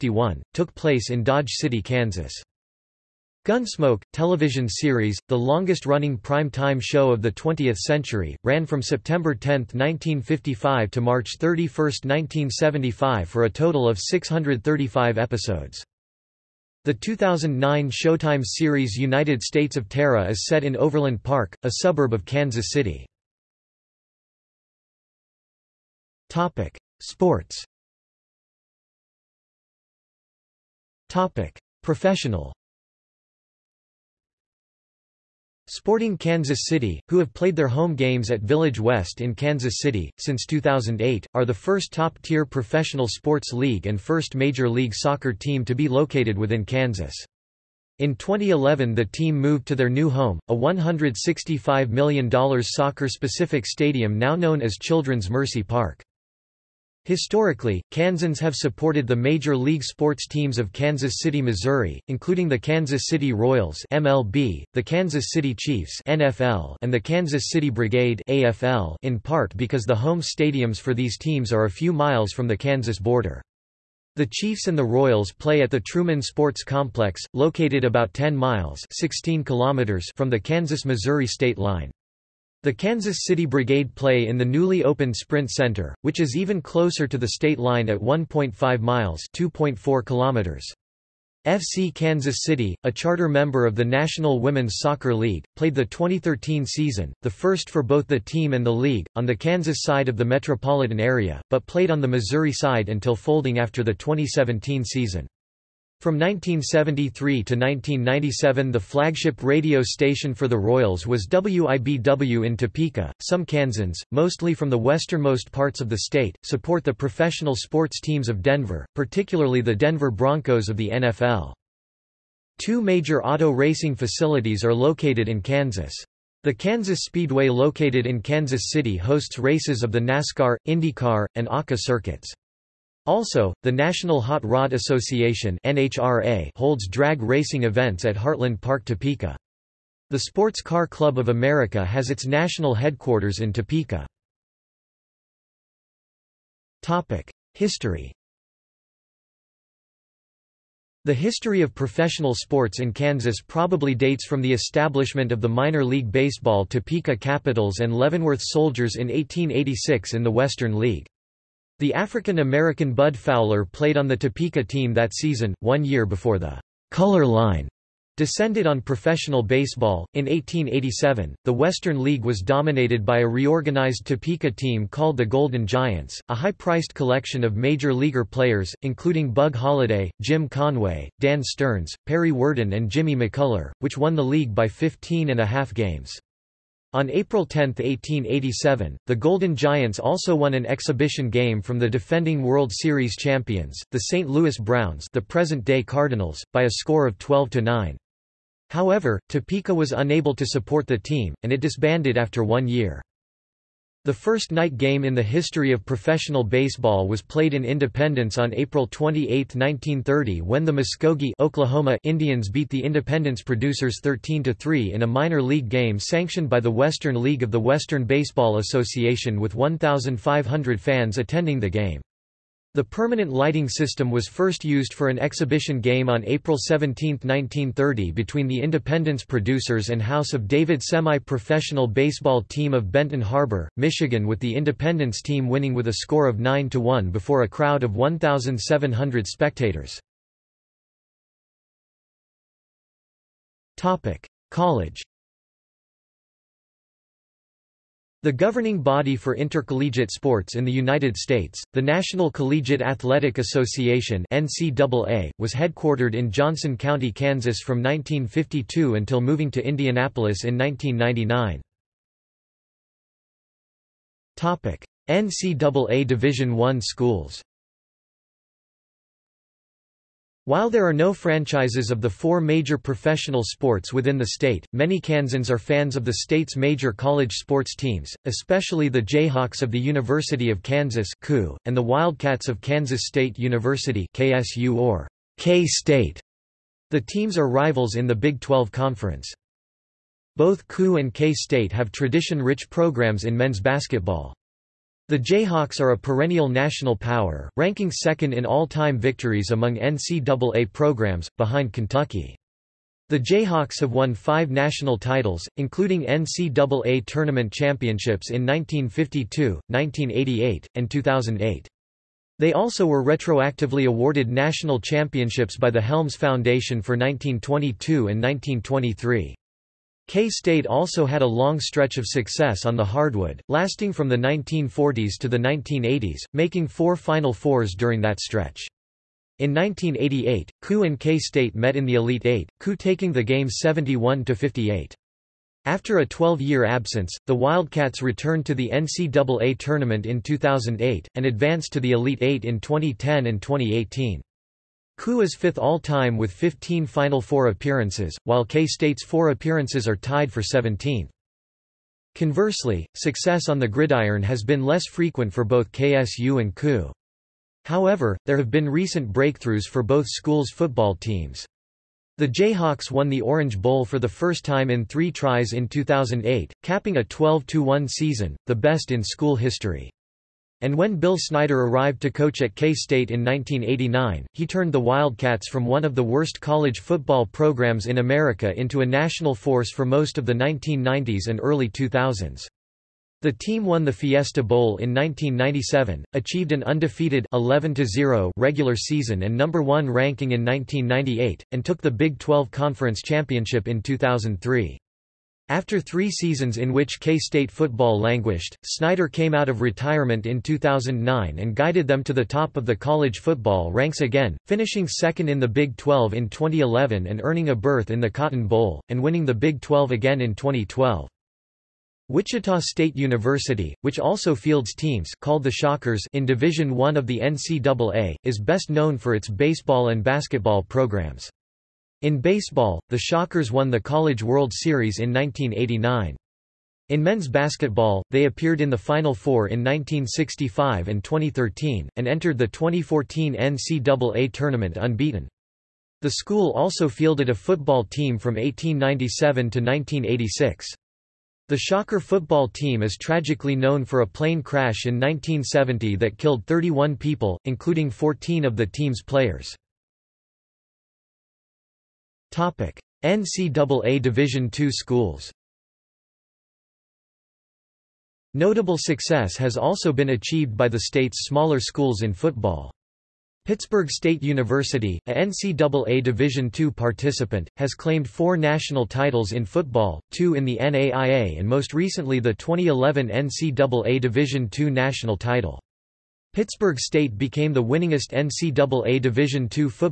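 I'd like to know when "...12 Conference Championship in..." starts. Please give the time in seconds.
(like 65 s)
392 s.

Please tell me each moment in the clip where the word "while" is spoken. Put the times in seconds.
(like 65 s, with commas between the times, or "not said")
270 s, 348 s.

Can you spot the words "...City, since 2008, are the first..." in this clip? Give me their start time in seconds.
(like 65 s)
39 s.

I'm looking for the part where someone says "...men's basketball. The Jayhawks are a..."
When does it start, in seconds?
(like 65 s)
293 s.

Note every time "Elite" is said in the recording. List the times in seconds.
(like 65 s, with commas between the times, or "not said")
331 s, 341 s.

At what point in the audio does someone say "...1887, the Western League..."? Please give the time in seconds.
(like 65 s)
170 s.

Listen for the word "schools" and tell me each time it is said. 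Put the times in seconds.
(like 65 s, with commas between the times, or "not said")
266 s, 360 s, 369 s, 436 s, 454 s, 461 s.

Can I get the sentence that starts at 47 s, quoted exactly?
In 2011 the team moved to their new home, a $165 million soccer-specific stadium now known as Children's Mercy Park.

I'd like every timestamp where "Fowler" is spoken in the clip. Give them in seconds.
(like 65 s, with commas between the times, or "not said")
163 s.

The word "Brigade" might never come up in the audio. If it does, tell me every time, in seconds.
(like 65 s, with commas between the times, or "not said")
67 s, 83 s.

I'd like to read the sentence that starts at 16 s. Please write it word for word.
The 2009 Showtime series United States of Tara is set in Overland Park, a suburb of Kansas City.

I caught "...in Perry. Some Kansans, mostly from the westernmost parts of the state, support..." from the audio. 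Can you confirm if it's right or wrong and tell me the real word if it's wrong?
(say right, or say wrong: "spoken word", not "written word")
wrong: "Topeka", not "Perry".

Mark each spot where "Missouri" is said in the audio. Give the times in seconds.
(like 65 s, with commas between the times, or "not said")
61 s, 80 s, 102 s.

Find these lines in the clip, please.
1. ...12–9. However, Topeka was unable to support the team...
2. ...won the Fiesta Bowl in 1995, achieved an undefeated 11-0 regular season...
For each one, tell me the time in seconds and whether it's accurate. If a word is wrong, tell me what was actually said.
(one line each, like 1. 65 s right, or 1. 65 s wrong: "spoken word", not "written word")
1. 197 s right
2. 383 s wrong: "1997", not "1995".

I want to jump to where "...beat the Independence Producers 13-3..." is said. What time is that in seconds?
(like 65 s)
212 s.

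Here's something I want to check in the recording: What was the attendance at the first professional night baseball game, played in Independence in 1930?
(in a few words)
1,500.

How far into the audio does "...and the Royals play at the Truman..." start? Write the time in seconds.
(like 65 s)
74 s.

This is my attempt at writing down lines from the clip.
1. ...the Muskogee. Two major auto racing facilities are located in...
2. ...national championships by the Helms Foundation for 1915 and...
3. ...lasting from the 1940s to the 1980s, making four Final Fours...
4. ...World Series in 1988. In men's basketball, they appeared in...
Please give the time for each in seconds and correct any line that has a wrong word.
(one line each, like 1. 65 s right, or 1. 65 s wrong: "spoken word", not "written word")
1. 120 s wrong: "NFL", not "Muskogee"
2. 314 s wrong: "1922", not "1915"
3. 323 s right
4. 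424 s wrong: "1989", not "1988".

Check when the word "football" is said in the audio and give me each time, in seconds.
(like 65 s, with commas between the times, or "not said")
360 s, 376 s, 397 s, 403 s, 437 s, 442 s, 462 s, 469 s.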